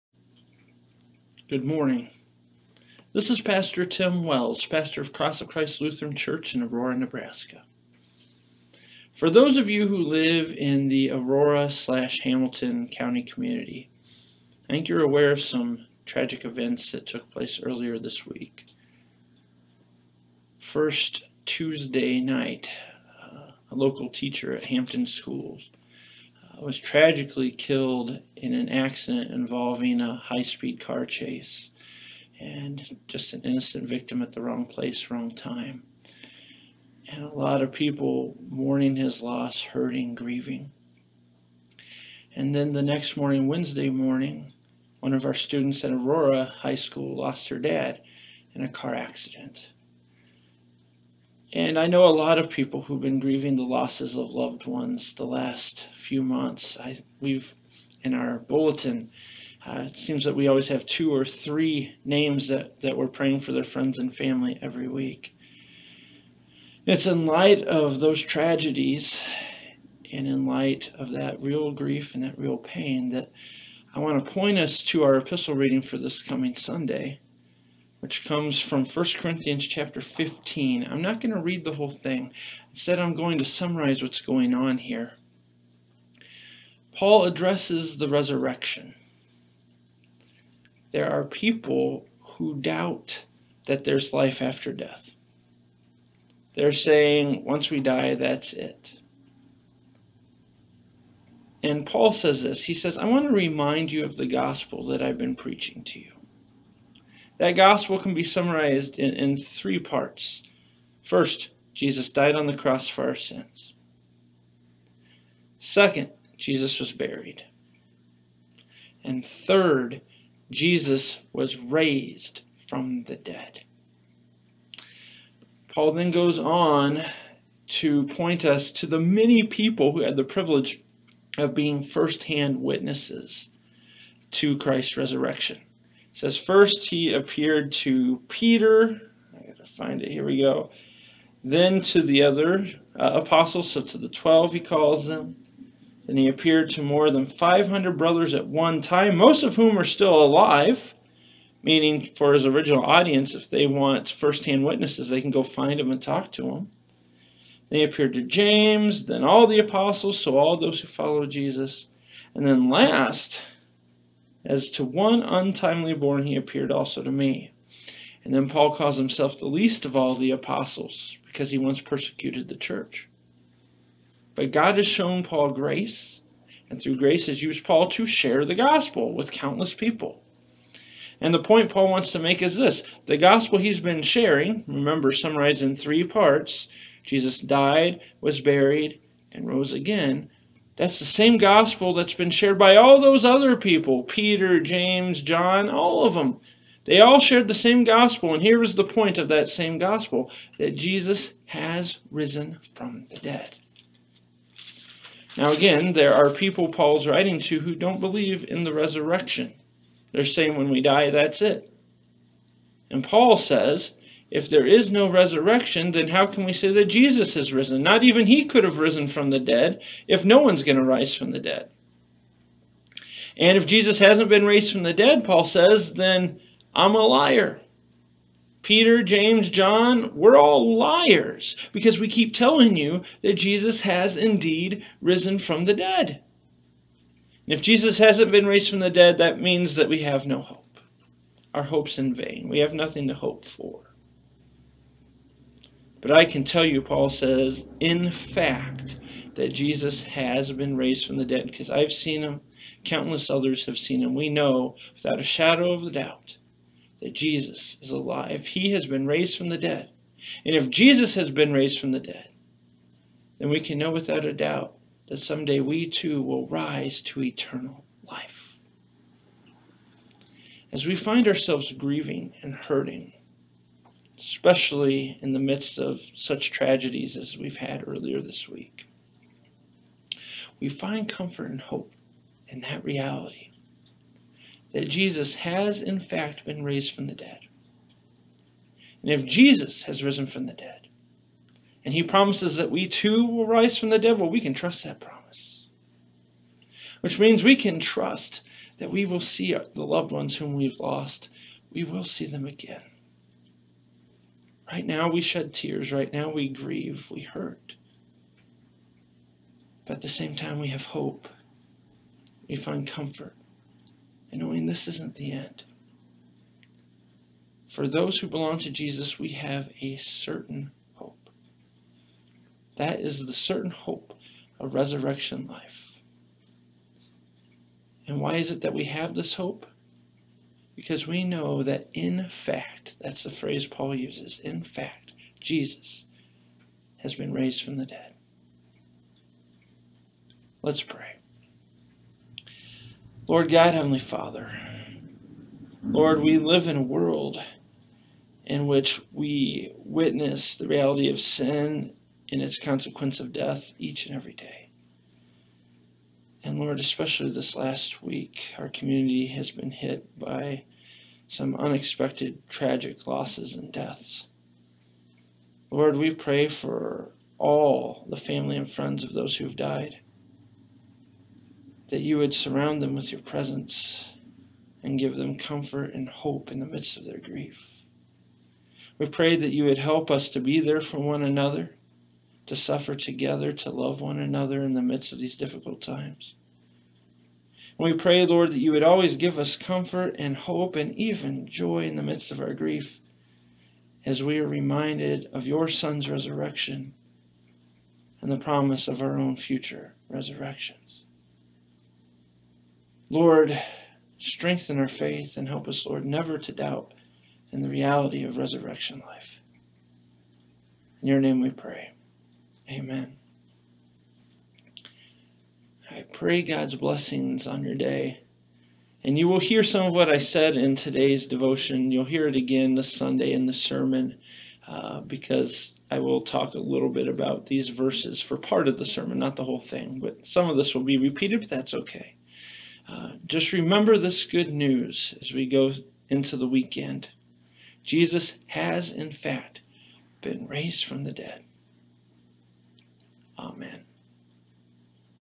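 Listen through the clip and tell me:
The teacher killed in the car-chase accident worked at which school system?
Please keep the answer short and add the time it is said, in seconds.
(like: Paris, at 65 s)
Hampton Schools, at 24 s.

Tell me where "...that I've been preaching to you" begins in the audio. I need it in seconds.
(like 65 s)
104 s.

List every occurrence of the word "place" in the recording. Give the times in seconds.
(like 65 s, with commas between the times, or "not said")
17 s, 34 s.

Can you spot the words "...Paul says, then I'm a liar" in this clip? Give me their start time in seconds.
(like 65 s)
225 s.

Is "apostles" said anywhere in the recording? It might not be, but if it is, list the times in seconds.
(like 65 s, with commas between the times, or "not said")
143 s, 159 s, 170 s.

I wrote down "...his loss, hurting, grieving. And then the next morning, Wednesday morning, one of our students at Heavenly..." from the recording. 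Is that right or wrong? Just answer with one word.
wrong.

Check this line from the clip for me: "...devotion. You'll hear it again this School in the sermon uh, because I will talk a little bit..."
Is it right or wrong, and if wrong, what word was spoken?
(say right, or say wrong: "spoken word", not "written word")
wrong: "Sunday", not "School".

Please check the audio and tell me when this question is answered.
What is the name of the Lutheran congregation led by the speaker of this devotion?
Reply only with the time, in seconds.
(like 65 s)
5 s.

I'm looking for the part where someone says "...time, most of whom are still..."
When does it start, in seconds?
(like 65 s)
148 s.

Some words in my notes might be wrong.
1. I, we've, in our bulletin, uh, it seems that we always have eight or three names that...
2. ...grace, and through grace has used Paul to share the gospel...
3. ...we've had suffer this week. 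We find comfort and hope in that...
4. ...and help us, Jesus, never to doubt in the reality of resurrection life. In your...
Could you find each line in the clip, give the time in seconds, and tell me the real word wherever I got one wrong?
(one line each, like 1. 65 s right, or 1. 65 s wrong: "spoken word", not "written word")
1. 56 s wrong: "two", not "eight"
2. 175 s right
3. 277 s wrong: "earlier", not "suffer"
4. 405 s wrong: "Lord", not "Jesus".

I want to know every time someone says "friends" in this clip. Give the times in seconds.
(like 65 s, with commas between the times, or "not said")
63 s, 368 s.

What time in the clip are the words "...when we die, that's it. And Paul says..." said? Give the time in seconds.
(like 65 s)
210 s.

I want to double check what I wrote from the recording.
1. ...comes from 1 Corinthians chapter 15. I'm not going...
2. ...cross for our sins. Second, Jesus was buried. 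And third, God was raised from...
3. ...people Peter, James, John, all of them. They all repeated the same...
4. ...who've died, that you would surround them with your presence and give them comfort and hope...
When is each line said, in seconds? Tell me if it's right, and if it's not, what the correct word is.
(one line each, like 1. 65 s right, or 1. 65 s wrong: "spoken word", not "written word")
1. 78 s right
2. 112 s wrong: "Jesus", not "God"
3. 193 s wrong: "shared", not "repeated"
4. 369 s right.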